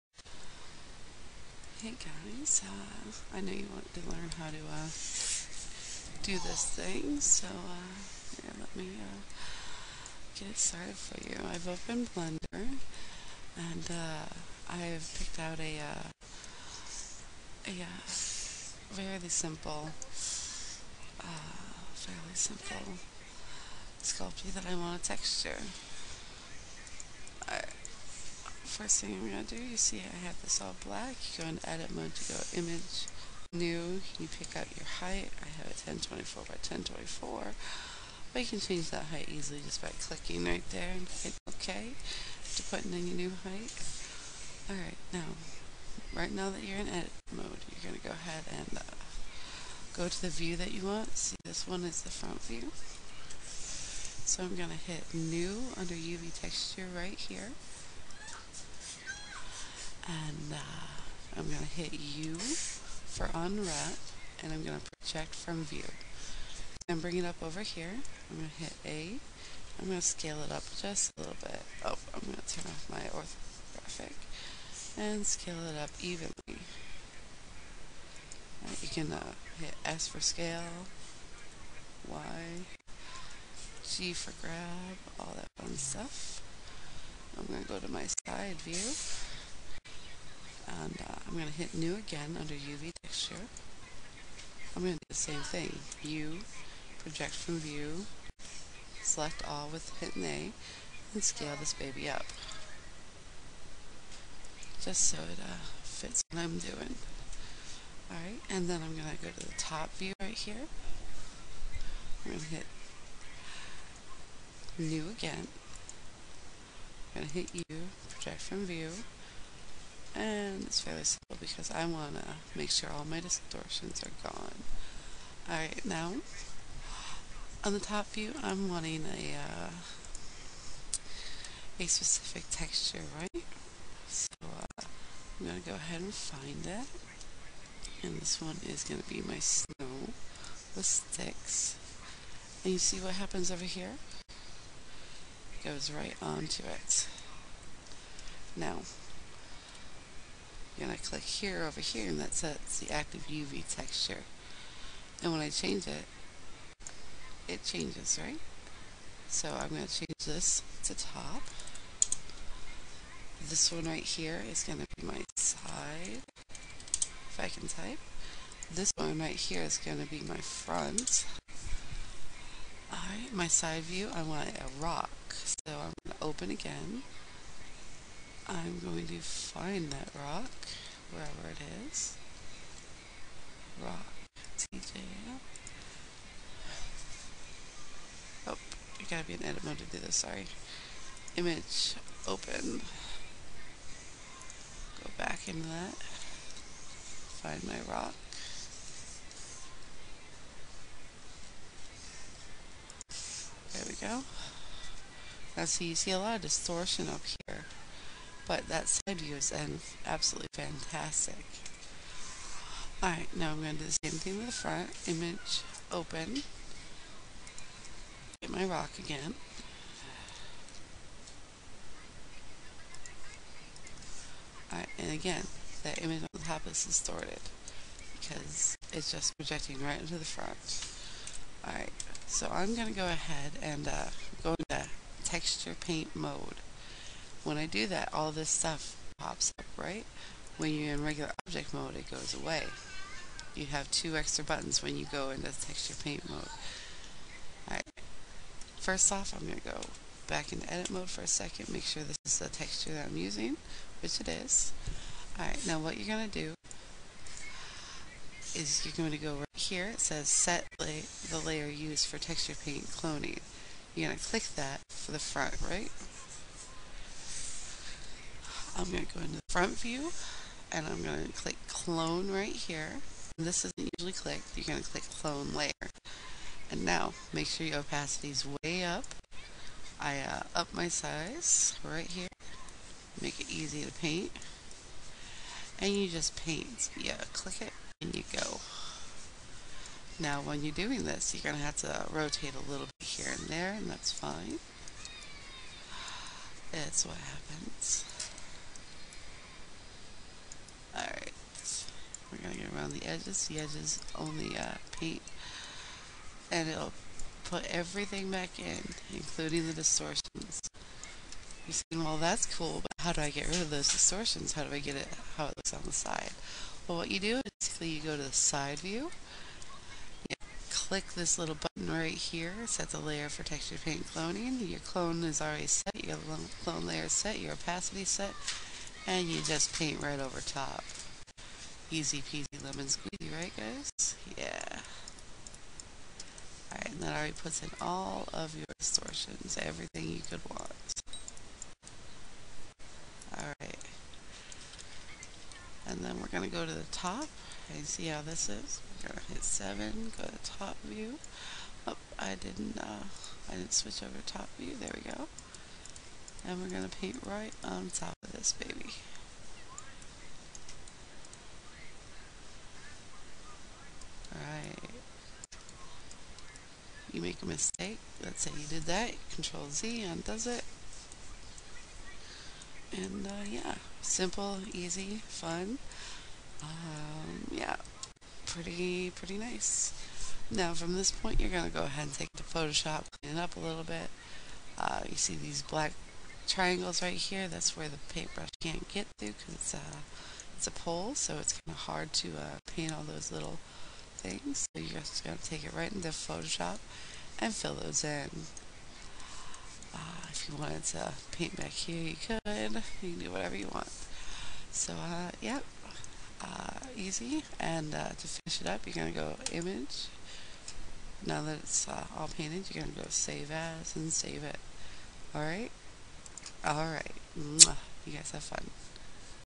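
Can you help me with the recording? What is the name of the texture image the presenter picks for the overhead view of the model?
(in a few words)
snow with sticks.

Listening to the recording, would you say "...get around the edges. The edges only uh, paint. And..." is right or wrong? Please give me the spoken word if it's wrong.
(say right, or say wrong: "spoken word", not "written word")
right.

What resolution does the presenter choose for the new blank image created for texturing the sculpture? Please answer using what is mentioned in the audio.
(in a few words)
1024 by 1024.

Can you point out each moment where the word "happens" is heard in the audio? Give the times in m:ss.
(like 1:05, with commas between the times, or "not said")
2:23, 4:57.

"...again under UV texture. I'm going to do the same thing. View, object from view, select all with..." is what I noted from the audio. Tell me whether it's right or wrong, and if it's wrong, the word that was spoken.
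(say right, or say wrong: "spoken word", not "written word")
wrong: "project", not "object".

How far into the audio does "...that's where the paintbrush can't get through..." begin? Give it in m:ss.
6:27.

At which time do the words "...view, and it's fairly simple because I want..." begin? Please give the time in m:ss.
1:58.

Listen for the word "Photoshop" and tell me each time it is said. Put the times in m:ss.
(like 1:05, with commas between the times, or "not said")
6:22, 6:36.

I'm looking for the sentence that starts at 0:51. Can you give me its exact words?
See, this one is the front view.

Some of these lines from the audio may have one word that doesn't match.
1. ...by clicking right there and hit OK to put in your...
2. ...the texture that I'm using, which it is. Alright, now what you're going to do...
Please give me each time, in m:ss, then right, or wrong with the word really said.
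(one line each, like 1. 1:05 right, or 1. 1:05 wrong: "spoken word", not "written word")
1. 0:39 right
2. 4:12 right.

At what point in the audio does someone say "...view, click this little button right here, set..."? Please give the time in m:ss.
5:18.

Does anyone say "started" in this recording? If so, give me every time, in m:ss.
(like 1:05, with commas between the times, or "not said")
0:10.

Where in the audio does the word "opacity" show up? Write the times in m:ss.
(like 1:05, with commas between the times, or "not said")
4:37, 5:27.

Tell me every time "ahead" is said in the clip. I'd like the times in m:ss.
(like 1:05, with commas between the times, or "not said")
0:48, 2:15, 3:53, 6:21.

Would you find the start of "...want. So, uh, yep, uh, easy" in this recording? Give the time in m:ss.
6:43.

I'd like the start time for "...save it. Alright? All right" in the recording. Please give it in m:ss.
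6:54.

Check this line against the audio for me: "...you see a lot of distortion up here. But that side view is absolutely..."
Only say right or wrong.
right.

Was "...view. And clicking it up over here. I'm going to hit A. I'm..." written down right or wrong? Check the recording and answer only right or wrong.
wrong.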